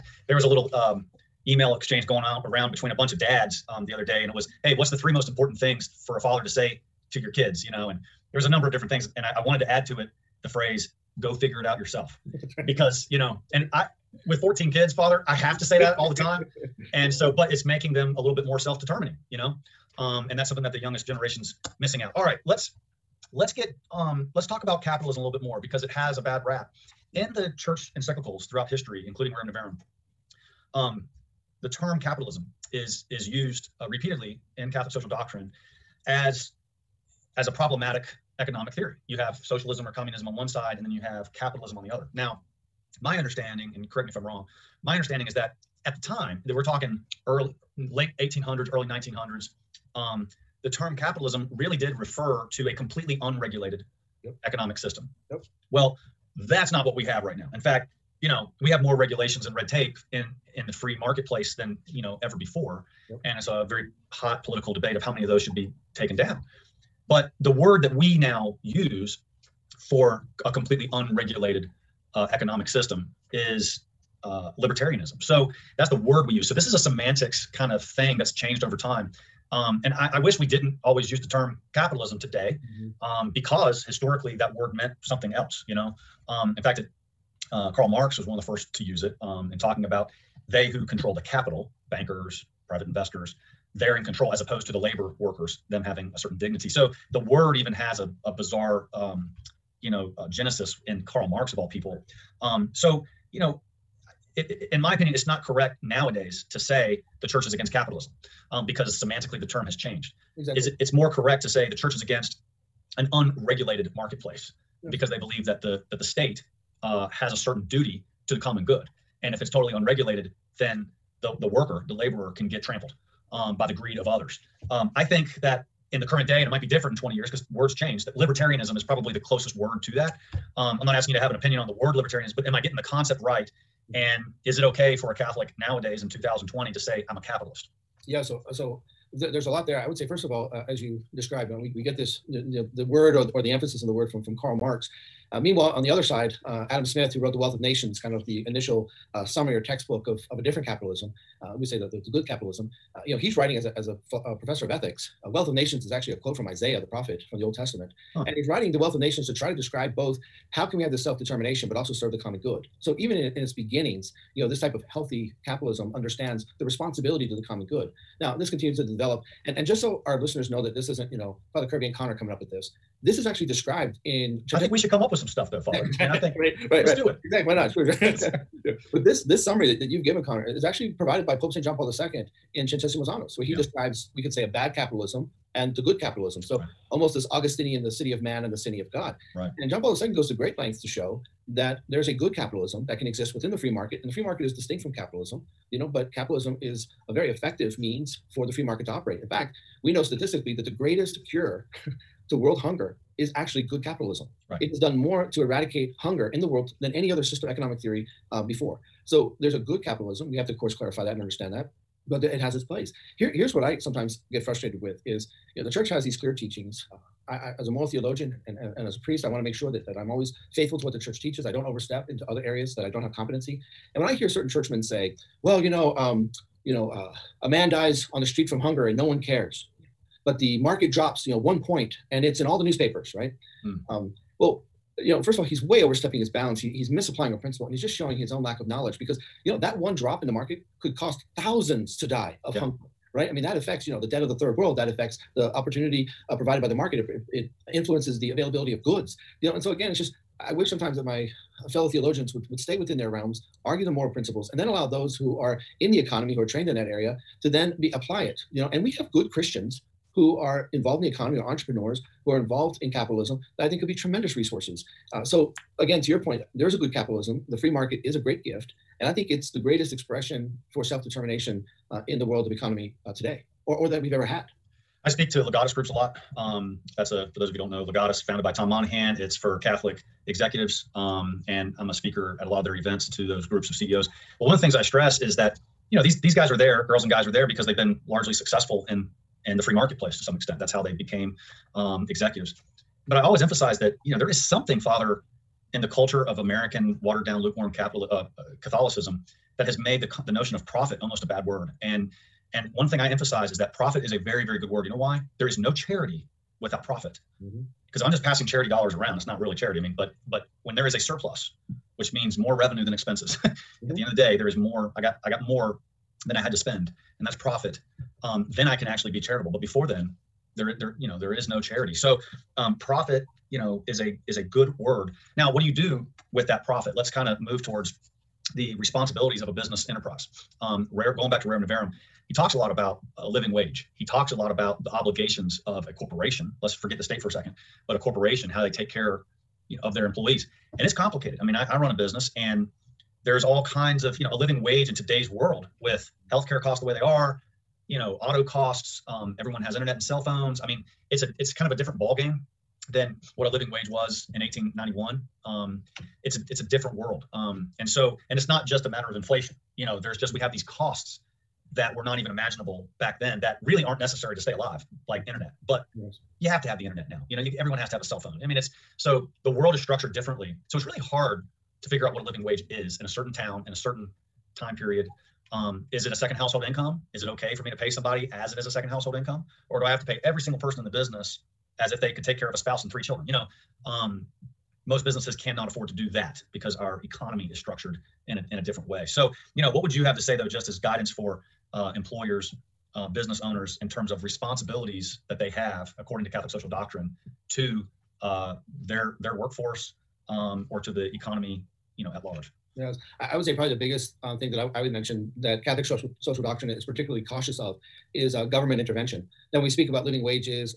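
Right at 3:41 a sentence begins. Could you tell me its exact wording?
I don't overstep into other areas that I don't have competency.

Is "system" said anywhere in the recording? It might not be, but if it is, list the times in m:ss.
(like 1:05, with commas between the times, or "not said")
0:54, 1:12, 3:27.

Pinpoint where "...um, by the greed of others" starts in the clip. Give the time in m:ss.
2:03.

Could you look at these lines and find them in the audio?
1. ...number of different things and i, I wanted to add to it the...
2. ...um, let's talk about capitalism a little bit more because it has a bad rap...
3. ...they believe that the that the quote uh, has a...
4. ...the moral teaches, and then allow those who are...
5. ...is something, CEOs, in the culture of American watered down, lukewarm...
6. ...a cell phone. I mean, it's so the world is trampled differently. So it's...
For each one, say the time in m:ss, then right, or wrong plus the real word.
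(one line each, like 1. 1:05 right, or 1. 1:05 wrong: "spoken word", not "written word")
1. 0:08 right
2. 0:23 right
3. 1:55 wrong: "state", not "quote"
4. 4:13 wrong: "principles", not "teaches"
5. 4:54 wrong: "Father", not "CEOs"
6. 6:07 wrong: "structured", not "trampled".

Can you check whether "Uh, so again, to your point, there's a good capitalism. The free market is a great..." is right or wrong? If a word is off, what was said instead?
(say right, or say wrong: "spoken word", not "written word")
right.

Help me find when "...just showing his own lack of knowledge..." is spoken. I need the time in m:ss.
3:57.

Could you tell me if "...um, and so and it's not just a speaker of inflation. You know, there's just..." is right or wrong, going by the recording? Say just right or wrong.
wrong.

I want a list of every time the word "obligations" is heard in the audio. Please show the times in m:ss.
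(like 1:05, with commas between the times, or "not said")
5:34.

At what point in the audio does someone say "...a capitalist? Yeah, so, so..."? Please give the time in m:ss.
2:17.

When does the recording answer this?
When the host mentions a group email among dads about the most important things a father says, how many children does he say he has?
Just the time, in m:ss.
0:14.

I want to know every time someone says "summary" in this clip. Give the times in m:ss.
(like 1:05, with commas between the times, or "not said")
2:29, 2:59.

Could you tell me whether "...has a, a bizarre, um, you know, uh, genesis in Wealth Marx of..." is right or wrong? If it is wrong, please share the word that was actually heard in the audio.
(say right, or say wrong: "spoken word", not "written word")
wrong: "Karl", not "Wealth".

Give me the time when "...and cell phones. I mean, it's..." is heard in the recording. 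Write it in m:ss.
5:49.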